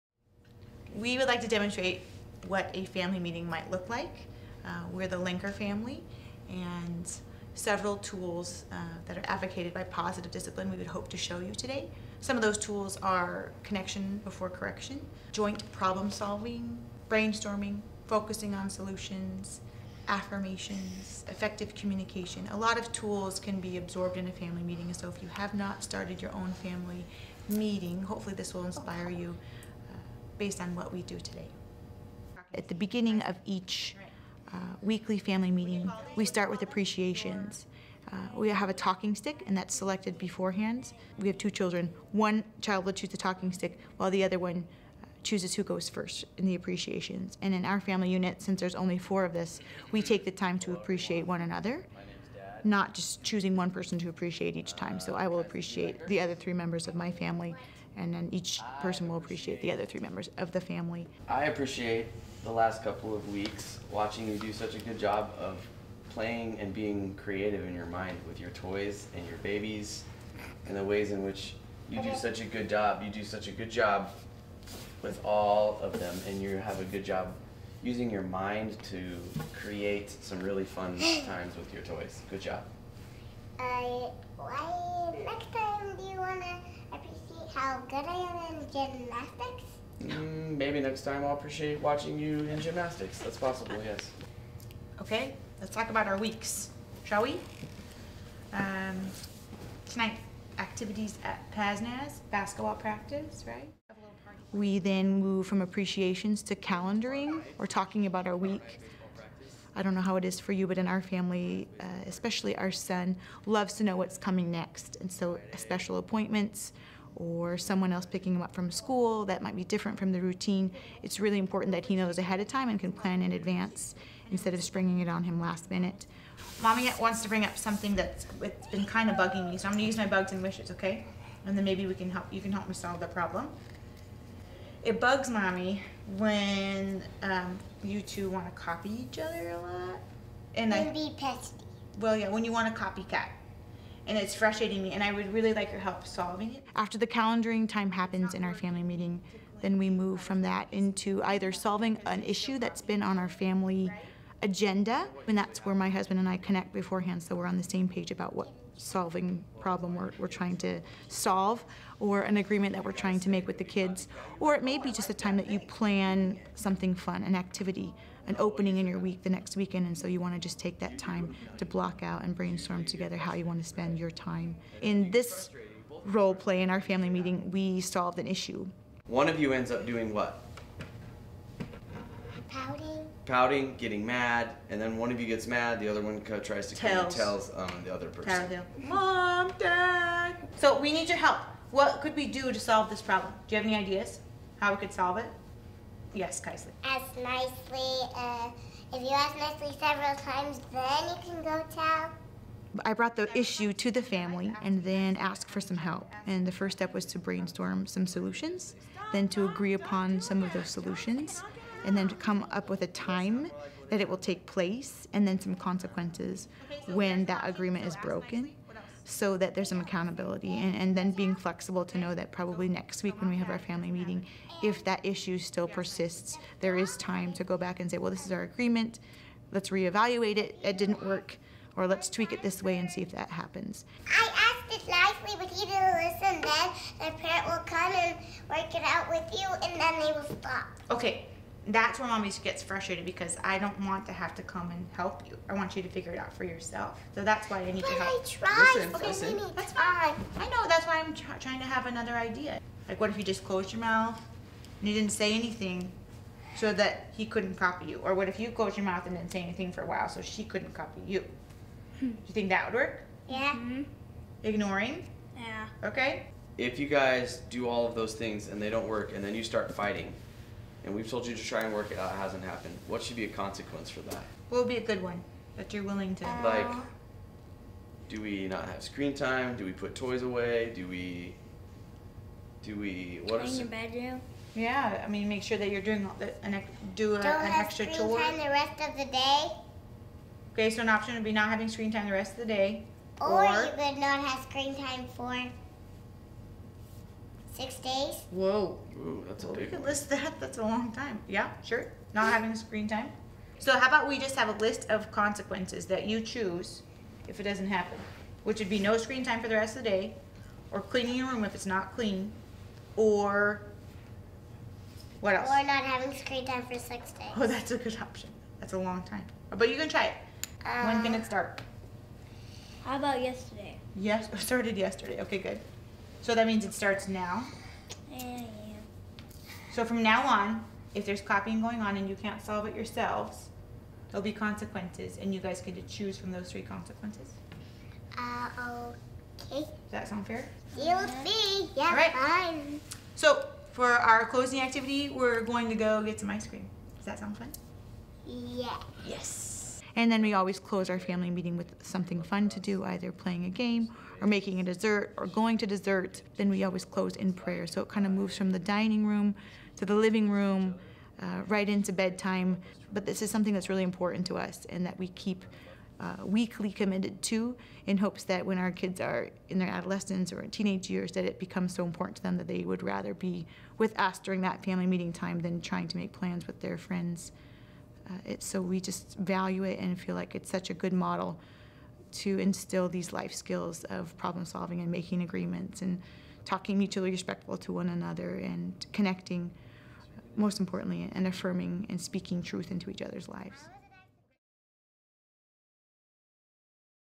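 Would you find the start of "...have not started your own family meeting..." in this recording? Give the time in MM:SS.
00:25.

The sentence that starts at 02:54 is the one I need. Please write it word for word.
In this role play in our family meeting, we solved an issue.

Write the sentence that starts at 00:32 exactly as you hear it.
At the beginning of each uh, weekly family meeting, we start with appreciations.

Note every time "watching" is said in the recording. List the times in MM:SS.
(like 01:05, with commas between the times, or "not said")
01:03, 01:31.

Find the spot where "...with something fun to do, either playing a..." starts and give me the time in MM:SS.
05:51.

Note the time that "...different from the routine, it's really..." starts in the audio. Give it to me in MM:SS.
01:59.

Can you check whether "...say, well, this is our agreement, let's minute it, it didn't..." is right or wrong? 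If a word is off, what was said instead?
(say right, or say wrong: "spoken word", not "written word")
wrong: "reevaluate", not "minute".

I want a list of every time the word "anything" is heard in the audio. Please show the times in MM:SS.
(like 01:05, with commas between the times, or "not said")
04:15, 04:19.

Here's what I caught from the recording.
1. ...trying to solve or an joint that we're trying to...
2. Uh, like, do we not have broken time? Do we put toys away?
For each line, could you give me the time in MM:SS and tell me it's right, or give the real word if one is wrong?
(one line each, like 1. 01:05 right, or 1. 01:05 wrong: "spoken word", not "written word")
1. 02:40 wrong: "agreement", not "joint"
2. 04:36 wrong: "screen", not "broken".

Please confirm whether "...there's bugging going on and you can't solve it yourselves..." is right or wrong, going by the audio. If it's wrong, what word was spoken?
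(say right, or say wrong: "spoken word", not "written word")
wrong: "copying", not "bugging".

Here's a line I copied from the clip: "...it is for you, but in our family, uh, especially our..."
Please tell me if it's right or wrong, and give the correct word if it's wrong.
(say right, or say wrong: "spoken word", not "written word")
right.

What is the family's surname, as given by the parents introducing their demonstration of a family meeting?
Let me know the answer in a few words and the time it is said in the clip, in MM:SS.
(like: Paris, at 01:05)
Lenker, at 00:05.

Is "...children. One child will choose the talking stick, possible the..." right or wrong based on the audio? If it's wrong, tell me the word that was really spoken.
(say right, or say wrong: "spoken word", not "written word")
wrong: "while", not "possible".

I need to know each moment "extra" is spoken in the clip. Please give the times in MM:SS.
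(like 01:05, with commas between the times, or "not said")
04:47.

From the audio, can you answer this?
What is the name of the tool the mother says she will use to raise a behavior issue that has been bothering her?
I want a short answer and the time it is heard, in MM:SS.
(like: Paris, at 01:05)
Bugs and wishes, at 02:10.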